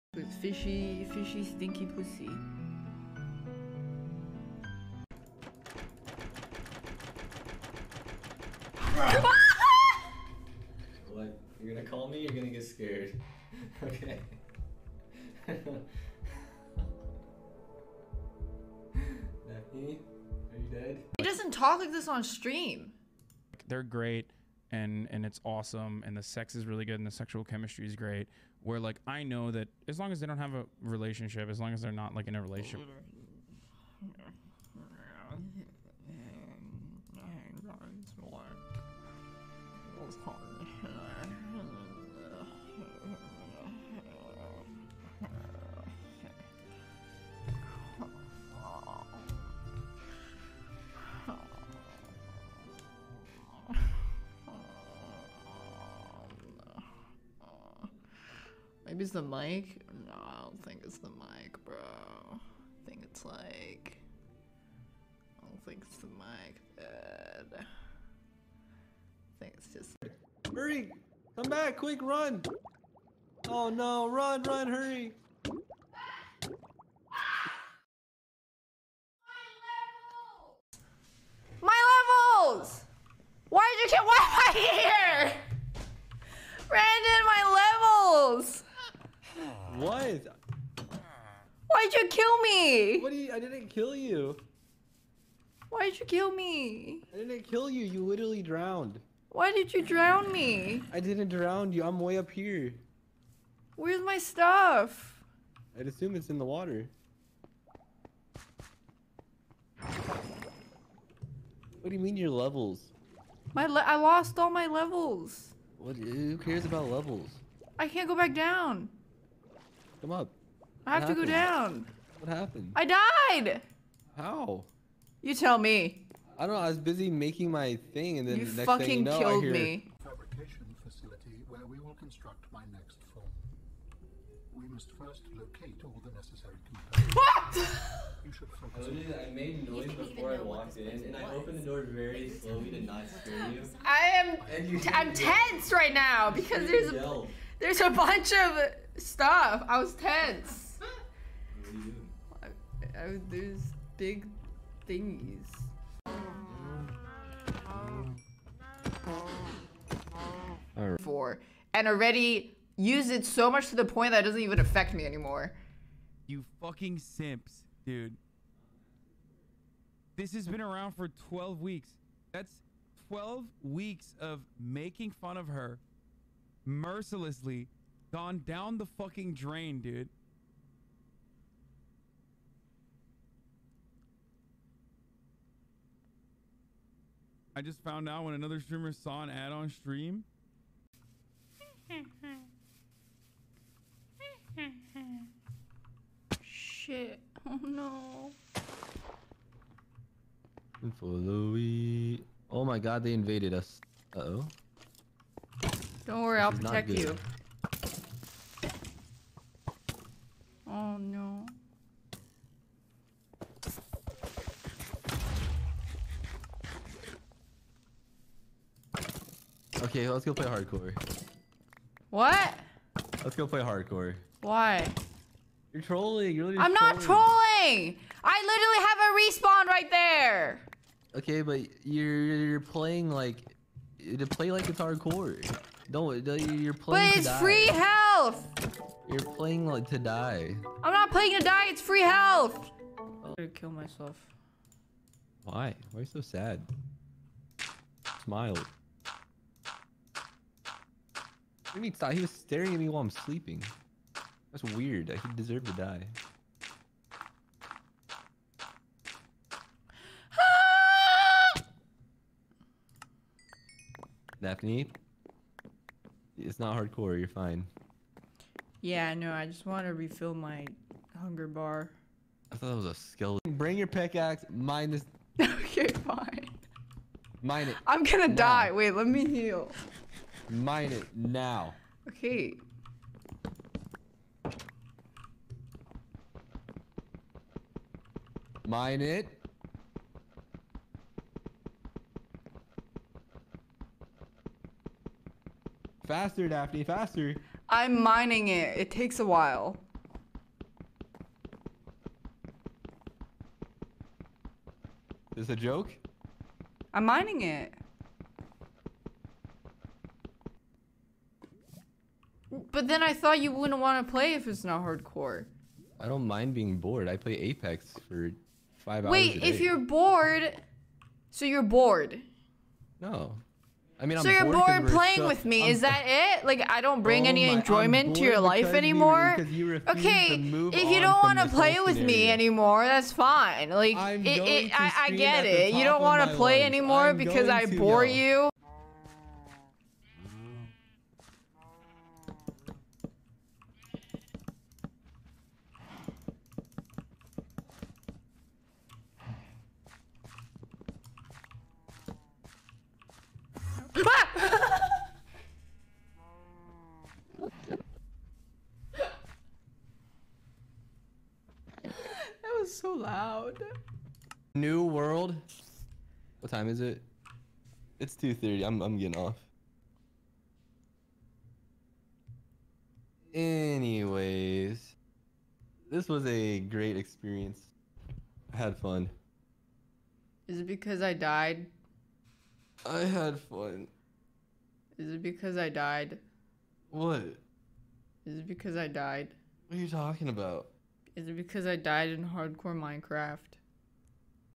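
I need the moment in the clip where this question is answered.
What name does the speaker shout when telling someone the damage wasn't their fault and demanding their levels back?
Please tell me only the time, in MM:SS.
01:26.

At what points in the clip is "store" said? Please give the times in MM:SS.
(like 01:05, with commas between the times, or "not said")
not said.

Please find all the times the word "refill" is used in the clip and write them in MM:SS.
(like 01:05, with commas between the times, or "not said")
04:29.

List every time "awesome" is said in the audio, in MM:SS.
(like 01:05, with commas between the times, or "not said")
00:25.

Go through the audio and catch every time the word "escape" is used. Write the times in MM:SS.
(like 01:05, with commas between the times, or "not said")
not said.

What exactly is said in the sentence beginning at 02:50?
This has been around for 12 weeks.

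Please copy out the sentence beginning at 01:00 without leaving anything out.
No, I don't think it's the mic, bro.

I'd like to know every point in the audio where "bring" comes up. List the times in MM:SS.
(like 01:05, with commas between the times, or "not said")
04:33, 05:27.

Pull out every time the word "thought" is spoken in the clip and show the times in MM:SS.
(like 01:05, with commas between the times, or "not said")
04:32, 05:13.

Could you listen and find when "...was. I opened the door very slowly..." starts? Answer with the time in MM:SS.
02:21.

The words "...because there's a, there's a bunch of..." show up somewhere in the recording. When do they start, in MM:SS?
02:26.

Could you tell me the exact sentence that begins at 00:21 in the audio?
He doesn't talk like this on stream.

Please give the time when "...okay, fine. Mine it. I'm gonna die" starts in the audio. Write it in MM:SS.
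04:35.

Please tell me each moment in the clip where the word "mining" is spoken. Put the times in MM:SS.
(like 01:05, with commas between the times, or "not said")
04:58, 05:07.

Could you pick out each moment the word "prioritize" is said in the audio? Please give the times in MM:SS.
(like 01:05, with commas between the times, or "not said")
not said.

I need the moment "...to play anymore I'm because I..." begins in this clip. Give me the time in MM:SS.
05:36.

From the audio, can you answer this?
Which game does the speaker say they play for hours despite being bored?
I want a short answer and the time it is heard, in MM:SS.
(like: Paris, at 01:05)
Apex, at 05:17.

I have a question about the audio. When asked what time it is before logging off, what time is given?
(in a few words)
2:30.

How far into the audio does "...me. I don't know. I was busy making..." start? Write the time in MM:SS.
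02:05.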